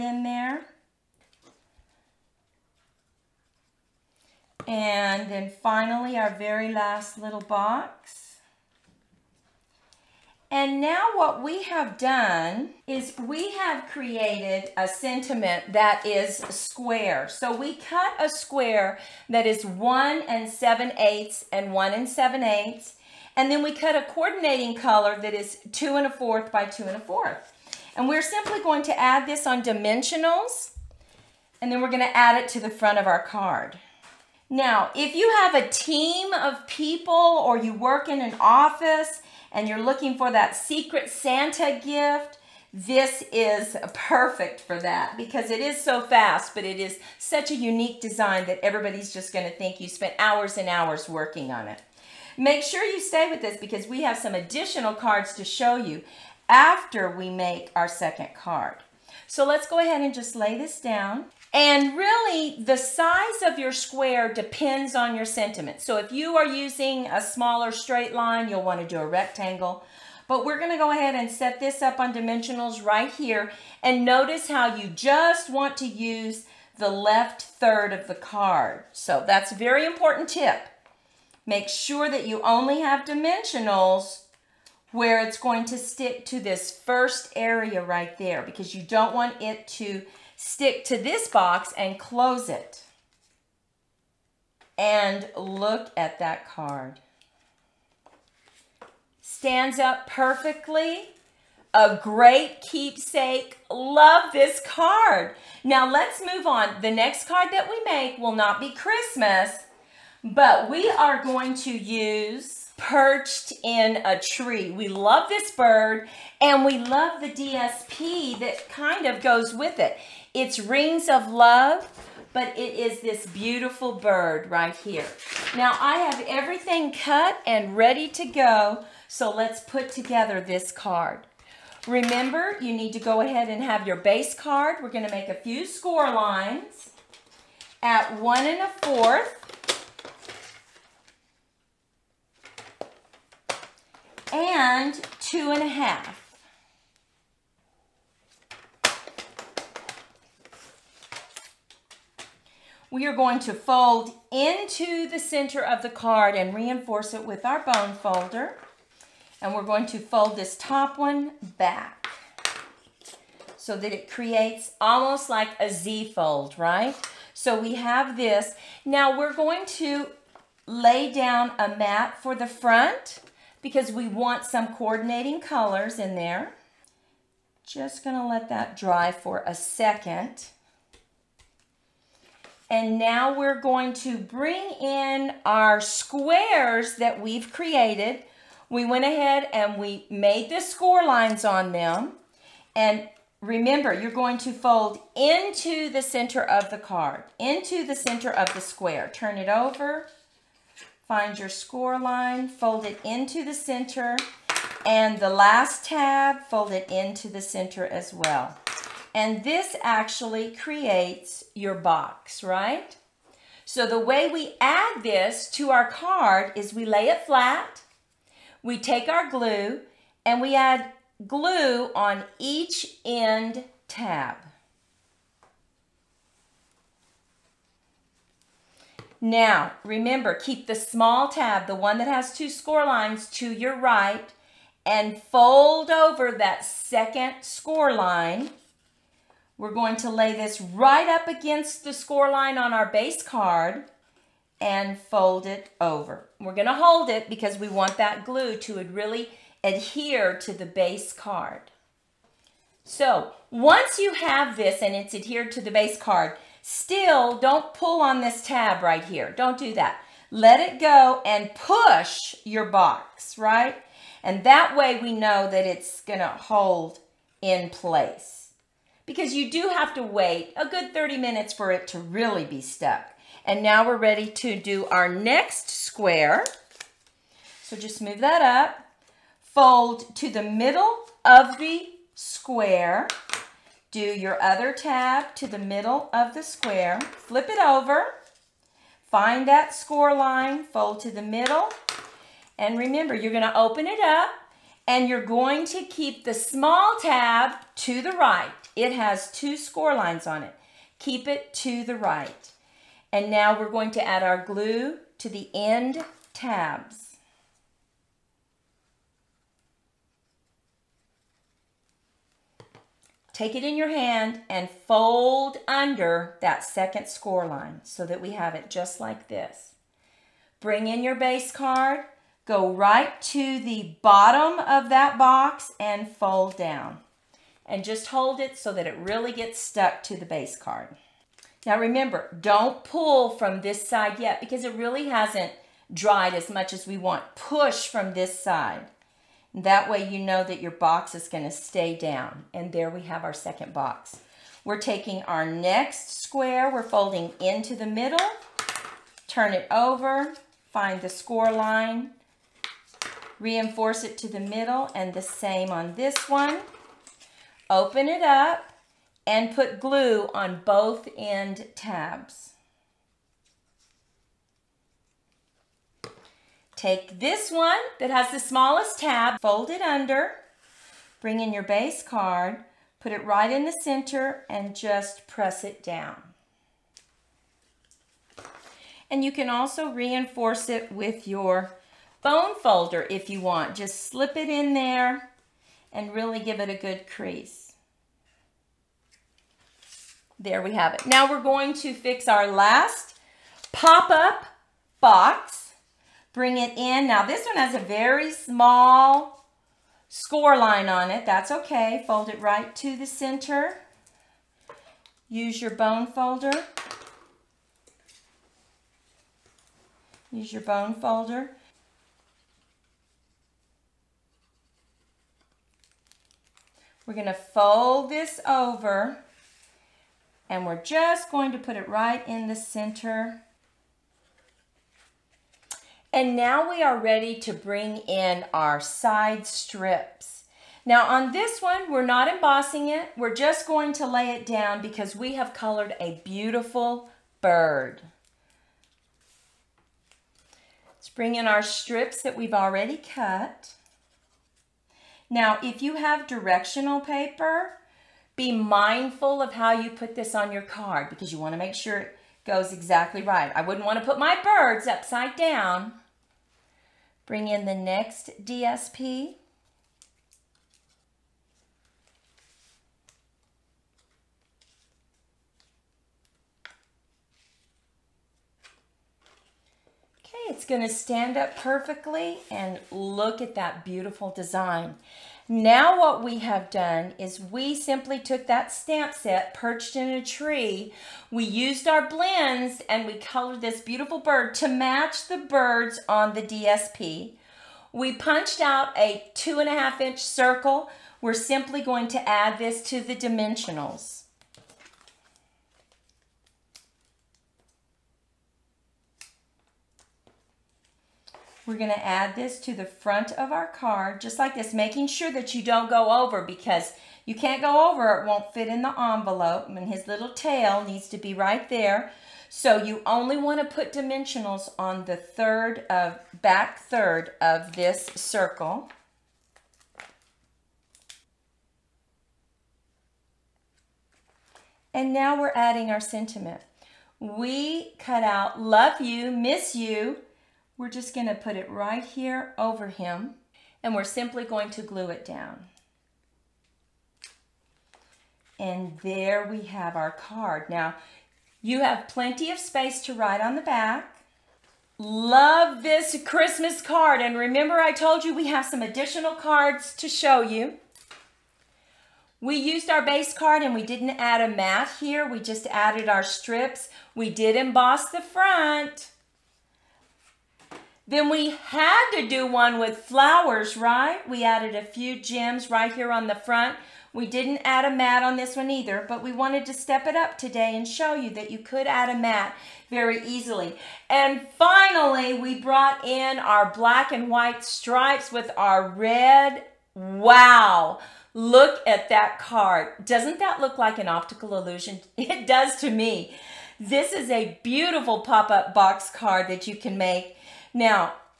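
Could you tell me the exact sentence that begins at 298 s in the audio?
It has two score lines on it.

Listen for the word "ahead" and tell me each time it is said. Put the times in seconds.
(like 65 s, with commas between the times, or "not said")
59 s, 70 s, 133 s, 189 s.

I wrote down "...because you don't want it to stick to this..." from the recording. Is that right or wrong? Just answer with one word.
right.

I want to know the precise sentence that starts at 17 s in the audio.
So we cut a square that is 1 and 7 eighths and 1 and 7 eighths.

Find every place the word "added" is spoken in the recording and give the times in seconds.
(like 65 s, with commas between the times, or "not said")
555 s, 564 s.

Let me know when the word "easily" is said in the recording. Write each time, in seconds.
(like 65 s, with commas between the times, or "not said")
573 s.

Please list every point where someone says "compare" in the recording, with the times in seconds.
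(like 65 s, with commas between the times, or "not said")
not said.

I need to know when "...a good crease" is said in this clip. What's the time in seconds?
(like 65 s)
386 s.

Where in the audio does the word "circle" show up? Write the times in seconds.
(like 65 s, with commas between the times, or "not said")
490 s, 518 s.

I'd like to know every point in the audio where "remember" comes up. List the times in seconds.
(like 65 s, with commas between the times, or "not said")
131 s, 193 s, 229 s, 292 s, 331 s, 547 s.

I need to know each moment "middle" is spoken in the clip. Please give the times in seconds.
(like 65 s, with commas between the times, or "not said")
280 s, 285 s, 291 s, 347 s, 354 s.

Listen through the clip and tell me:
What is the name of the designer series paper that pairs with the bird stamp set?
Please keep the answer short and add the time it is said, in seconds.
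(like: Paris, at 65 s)
Rings of Love, at 120 s.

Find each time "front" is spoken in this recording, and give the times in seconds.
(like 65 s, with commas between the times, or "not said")
32 s, 172 s, 502 s, 558 s, 566 s.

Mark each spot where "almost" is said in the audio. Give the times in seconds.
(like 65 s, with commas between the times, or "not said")
164 s.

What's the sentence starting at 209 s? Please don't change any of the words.
And this actually creates your box, right?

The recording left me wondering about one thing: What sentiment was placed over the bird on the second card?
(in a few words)
Love you, miss you.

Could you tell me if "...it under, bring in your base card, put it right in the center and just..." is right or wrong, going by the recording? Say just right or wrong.
right.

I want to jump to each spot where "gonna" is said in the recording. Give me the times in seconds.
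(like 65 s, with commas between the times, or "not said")
134 s, 178 s, 246 s, 266 s, 293 s, 341 s, 417 s, 470 s.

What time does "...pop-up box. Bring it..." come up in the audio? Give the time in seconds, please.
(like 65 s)
393 s.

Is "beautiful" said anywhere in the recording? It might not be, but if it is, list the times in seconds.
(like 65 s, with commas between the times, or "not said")
123 s, 436 s, 473 s, 483 s, 587 s.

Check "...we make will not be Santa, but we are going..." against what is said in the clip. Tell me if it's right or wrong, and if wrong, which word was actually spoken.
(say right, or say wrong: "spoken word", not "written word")
wrong: "Christmas", not "Santa".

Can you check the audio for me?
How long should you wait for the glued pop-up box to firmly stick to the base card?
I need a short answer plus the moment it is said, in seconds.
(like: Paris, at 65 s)
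30 minutes, at 270 s.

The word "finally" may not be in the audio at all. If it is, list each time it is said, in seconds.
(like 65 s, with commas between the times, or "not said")
5 s, 574 s.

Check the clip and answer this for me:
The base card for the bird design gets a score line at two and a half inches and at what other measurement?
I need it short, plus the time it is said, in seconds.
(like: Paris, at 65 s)
1 1/4 inches, at 138 s.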